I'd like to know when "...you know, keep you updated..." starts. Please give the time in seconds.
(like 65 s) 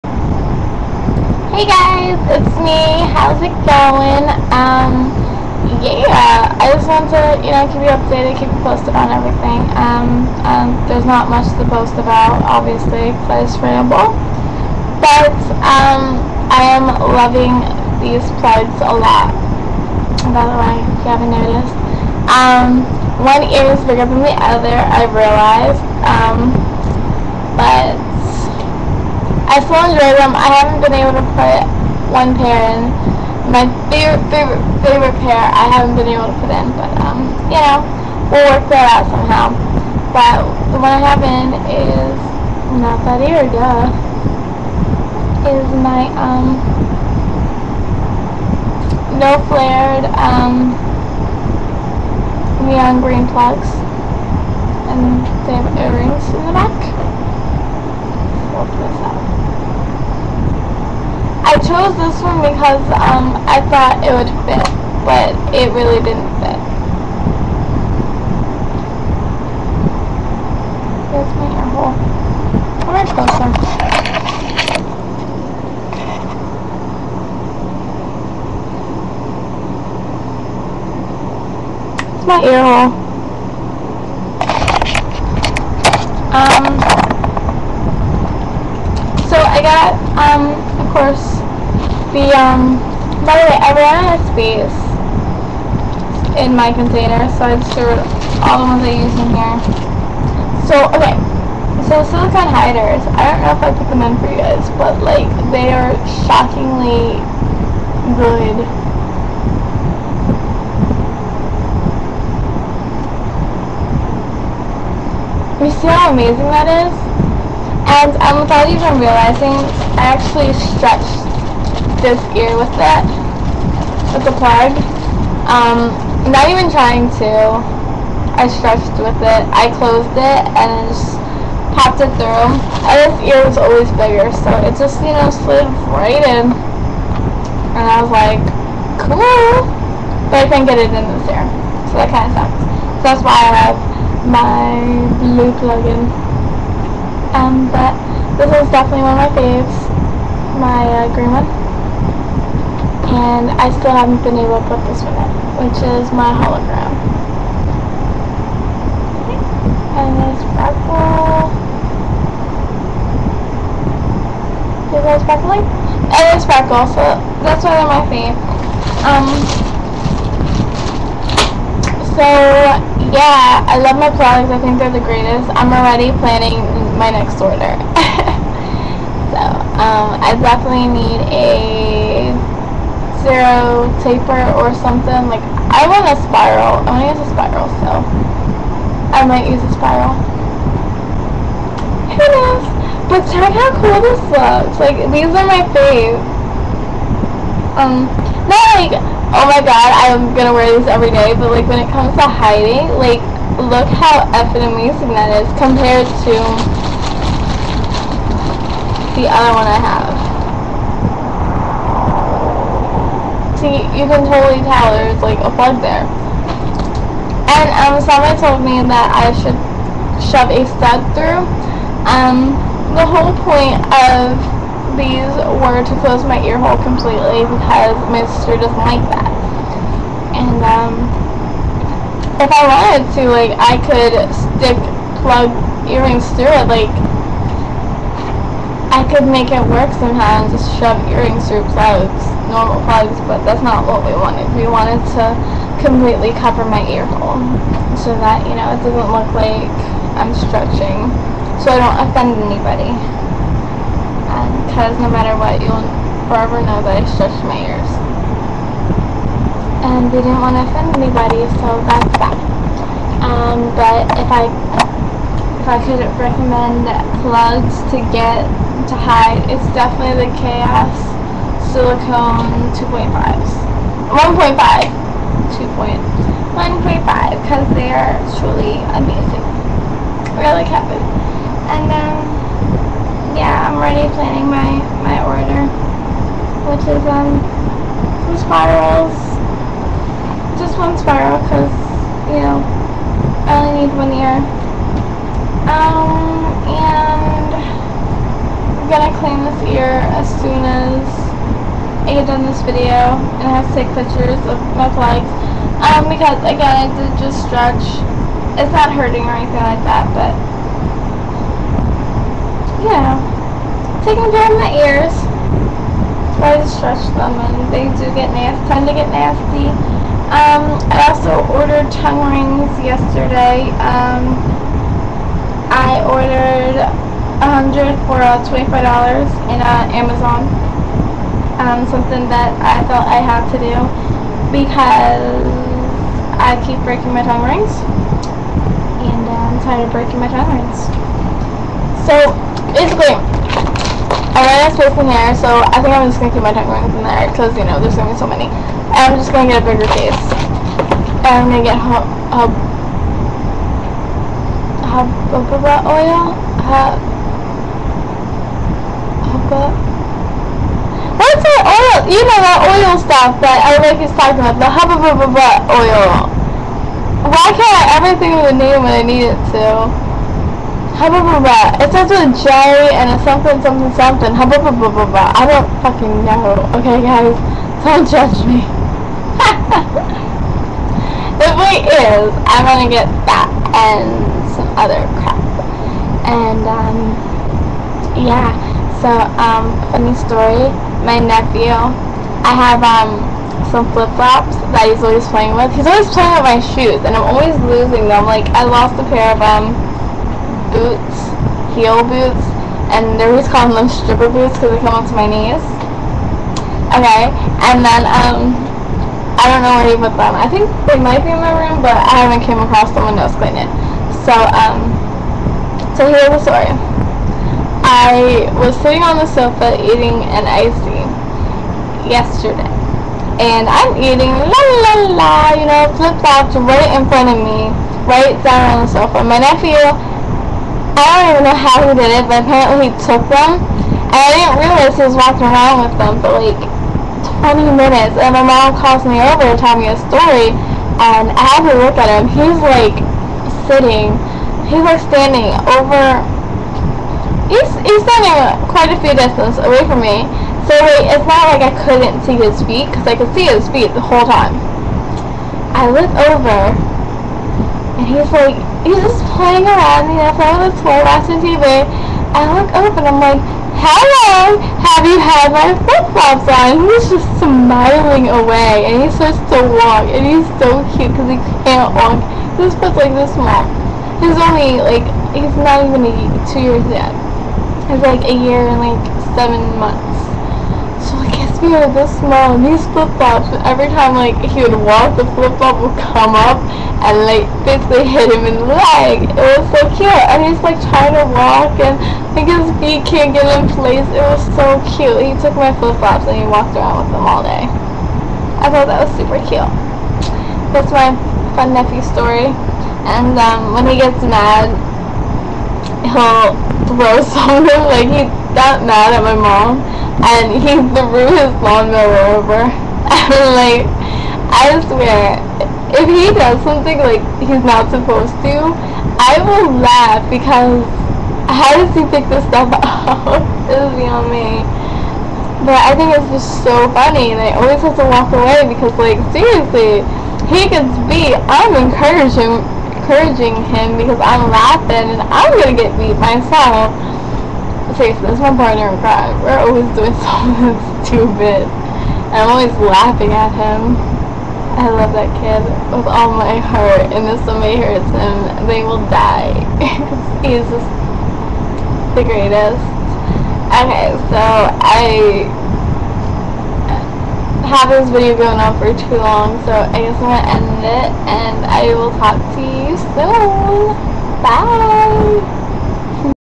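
7 s.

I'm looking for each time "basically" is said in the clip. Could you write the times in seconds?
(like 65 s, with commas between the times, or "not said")
342 s, 487 s.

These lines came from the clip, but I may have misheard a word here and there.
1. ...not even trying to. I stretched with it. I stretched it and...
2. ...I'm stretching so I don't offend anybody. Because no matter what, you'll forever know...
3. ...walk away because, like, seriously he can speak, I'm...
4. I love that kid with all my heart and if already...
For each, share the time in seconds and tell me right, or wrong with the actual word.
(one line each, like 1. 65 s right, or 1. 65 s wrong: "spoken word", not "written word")
1. 126 s wrong: "closed", not "stretched"
2. 250 s right
3. 528 s right
4. 544 s wrong: "somebody", not "already".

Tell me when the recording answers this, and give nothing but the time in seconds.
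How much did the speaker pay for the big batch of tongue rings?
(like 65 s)
328 s.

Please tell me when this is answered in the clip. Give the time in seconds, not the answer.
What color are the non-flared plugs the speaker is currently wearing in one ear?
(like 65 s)
52 s.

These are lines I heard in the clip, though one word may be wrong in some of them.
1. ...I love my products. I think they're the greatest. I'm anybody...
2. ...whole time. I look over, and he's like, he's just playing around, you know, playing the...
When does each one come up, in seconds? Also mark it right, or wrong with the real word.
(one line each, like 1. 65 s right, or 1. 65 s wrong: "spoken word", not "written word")
1. 173 s wrong: "already", not "anybody"
2. 454 s right.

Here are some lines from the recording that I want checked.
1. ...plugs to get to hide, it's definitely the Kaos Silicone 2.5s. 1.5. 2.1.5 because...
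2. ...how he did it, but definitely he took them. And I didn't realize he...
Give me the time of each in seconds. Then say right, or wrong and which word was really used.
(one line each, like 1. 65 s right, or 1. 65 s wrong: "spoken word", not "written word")
1. 267 s right
2. 431 s wrong: "apparently", not "definitely".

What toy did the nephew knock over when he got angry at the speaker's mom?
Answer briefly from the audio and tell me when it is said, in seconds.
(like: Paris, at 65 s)
Lawnmower, at 511 s.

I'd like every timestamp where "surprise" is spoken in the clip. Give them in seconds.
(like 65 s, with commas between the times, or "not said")
not said.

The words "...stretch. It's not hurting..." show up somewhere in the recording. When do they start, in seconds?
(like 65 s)
307 s.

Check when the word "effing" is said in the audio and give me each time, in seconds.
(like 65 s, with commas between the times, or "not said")
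204 s.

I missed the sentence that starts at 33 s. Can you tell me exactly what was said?
My favorite, favorite, favorite pair I haven't been able to put in, but, um, you know, we'll work that out somehow.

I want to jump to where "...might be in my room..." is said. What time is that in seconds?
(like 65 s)
410 s.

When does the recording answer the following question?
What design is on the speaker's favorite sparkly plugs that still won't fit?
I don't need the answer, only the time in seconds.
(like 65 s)
156 s.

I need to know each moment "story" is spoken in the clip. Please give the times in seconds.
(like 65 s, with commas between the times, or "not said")
390 s, 416 s, 440 s, 502 s.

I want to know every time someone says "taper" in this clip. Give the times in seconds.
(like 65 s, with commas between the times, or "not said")
184 s.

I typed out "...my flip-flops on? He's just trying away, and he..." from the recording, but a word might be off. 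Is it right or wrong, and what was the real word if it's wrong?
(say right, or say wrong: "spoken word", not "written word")
wrong: "smiling", not "trying".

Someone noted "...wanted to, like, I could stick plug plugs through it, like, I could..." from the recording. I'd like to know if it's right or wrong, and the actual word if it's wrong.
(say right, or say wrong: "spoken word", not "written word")
wrong: "earrings", not "plugs".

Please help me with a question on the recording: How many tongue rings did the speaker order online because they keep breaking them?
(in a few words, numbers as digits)
100.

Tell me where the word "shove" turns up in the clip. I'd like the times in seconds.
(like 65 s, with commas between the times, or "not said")
220 s, 240 s.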